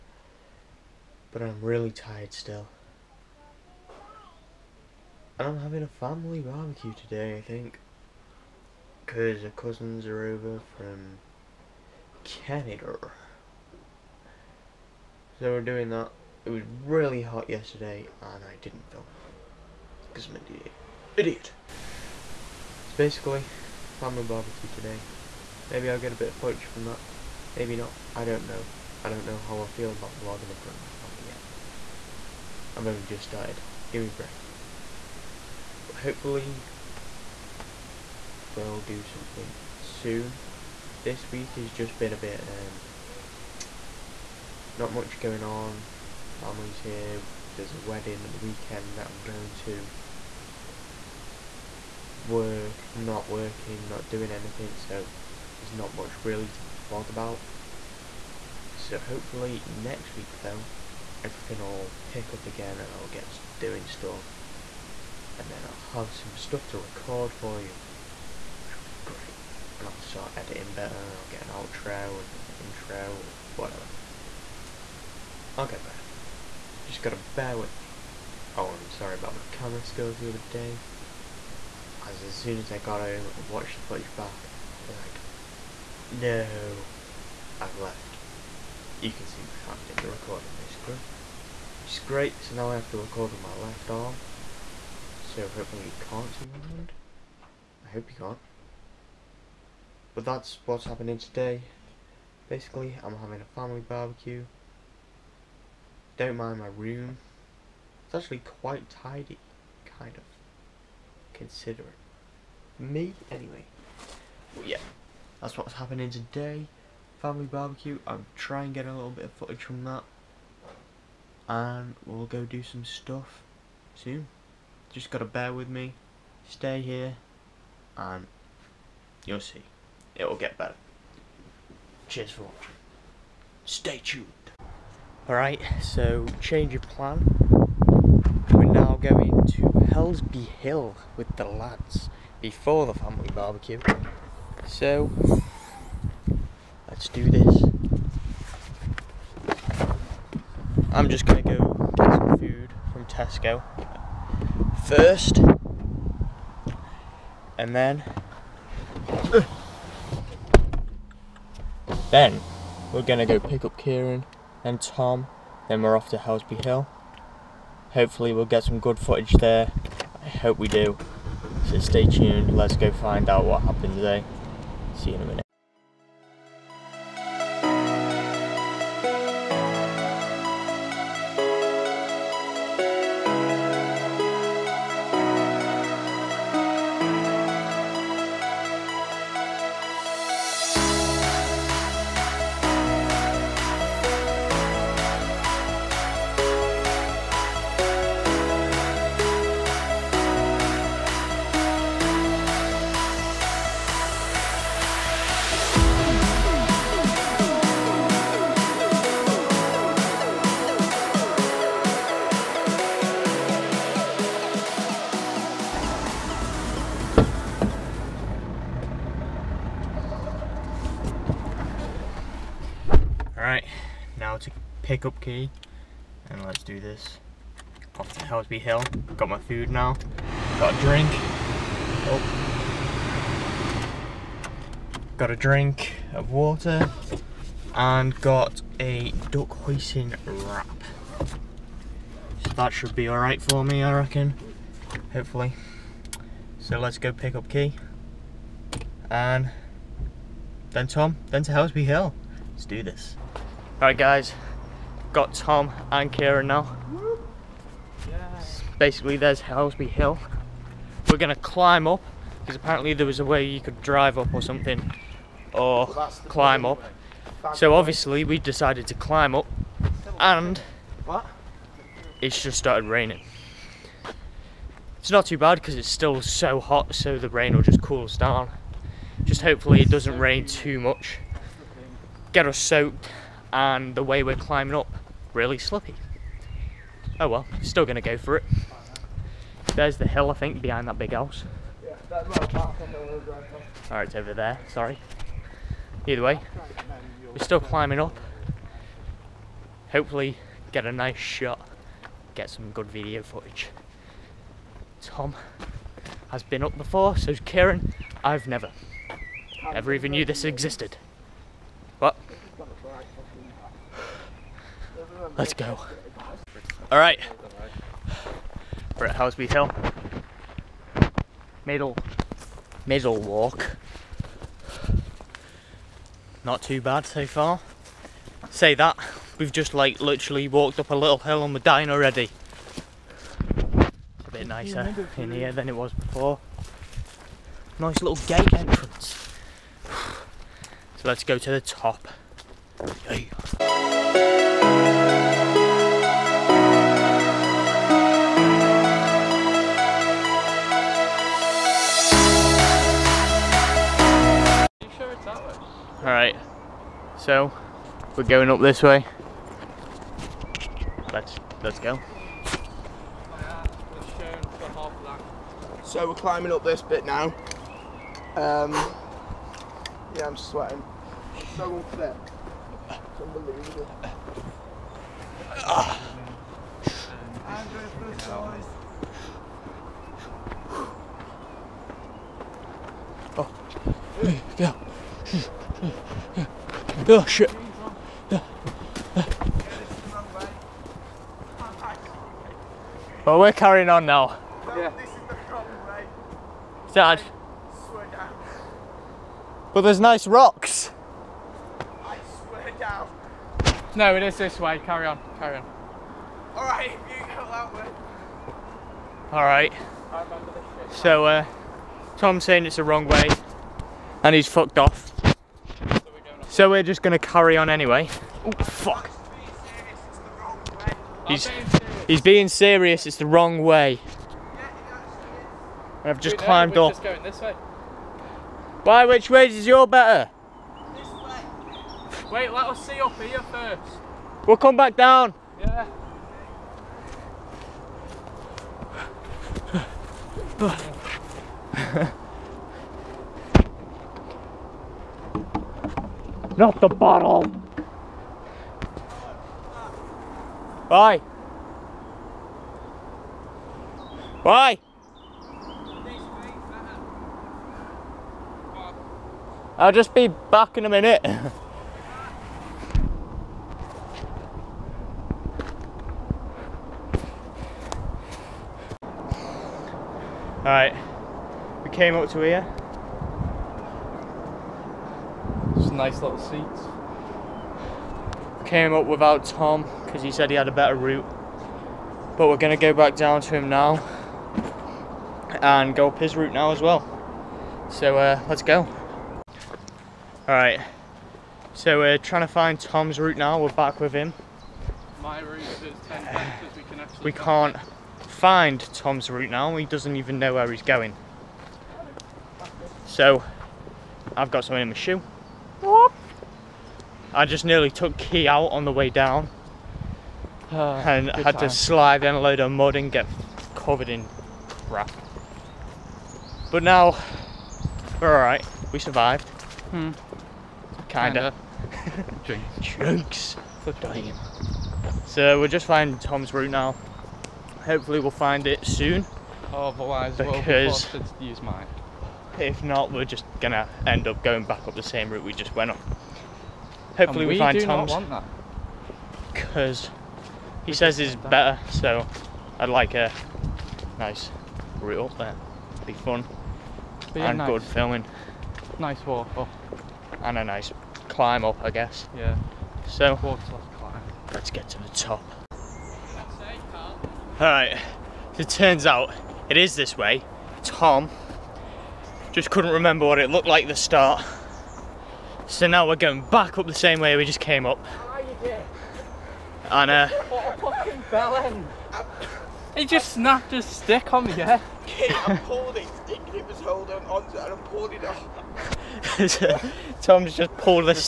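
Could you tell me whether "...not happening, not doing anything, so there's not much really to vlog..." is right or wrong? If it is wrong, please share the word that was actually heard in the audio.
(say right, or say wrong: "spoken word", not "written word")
wrong: "working", not "happening".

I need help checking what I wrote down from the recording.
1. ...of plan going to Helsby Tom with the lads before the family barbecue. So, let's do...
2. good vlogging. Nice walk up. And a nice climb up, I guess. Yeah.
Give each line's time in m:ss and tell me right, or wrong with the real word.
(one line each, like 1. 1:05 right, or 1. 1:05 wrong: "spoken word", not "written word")
1. 2:16 wrong: "Hill", not "Tom"
2. 9:07 wrong: "filming", not "vlogging".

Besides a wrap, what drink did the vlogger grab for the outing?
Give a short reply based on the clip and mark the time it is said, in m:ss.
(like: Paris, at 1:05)
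Water, at 3:56.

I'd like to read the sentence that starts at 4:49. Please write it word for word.
There's the hill, I think, behind that big house.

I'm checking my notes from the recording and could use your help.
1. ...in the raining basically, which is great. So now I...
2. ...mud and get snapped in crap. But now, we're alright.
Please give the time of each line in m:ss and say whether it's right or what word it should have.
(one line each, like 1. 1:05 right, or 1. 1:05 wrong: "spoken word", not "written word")
1. 1:29 wrong: "recording", not "raining"
2. 8:32 wrong: "covered", not "snapped".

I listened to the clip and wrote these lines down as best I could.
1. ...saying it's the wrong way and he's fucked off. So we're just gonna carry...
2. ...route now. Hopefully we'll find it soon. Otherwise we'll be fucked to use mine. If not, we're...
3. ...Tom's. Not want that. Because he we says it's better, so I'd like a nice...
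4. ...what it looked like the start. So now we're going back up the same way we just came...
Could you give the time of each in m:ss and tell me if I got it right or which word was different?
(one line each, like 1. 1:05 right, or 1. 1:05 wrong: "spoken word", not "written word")
1. 6:52 right
2. 8:46 wrong: "forced", not "fucked"
3. 8:57 right
4. 9:23 right.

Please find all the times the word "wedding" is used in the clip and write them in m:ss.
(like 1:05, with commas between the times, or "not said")
0:47.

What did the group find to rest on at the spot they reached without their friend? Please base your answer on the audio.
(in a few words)
Seats.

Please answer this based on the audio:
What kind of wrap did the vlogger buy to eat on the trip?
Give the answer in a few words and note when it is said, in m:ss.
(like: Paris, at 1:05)
Duck hoisin wrap, at 3:59.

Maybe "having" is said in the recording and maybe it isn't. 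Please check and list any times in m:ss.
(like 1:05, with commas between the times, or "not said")
0:05, 1:43.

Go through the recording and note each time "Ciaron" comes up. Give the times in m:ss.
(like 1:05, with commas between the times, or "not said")
2:43, 4:16, 5:07.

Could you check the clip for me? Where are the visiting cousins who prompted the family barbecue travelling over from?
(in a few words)
Canada.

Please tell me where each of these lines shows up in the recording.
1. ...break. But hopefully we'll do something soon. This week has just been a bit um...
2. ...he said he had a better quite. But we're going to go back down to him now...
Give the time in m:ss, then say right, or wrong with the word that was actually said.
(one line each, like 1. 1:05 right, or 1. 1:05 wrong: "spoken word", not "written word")
1. 0:34 right
2. 8:00 wrong: "route", not "quite".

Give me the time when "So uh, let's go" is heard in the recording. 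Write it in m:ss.
8:07.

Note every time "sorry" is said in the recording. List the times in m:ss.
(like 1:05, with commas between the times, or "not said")
1:18, 4:54.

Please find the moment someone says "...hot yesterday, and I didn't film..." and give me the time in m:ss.
0:17.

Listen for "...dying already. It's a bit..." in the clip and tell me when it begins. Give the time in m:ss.
5:31.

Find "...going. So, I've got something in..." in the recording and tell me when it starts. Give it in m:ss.
8:20.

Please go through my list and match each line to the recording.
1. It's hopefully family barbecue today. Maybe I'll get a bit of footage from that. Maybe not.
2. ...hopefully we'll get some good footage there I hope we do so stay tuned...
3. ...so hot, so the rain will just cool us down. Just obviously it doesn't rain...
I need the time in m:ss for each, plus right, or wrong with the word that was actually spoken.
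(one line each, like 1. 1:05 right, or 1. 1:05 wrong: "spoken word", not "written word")
1. 0:22 wrong: "basically", not "hopefully"
2. 2:47 right
3. 4:36 wrong: "hopefully", not "obviously".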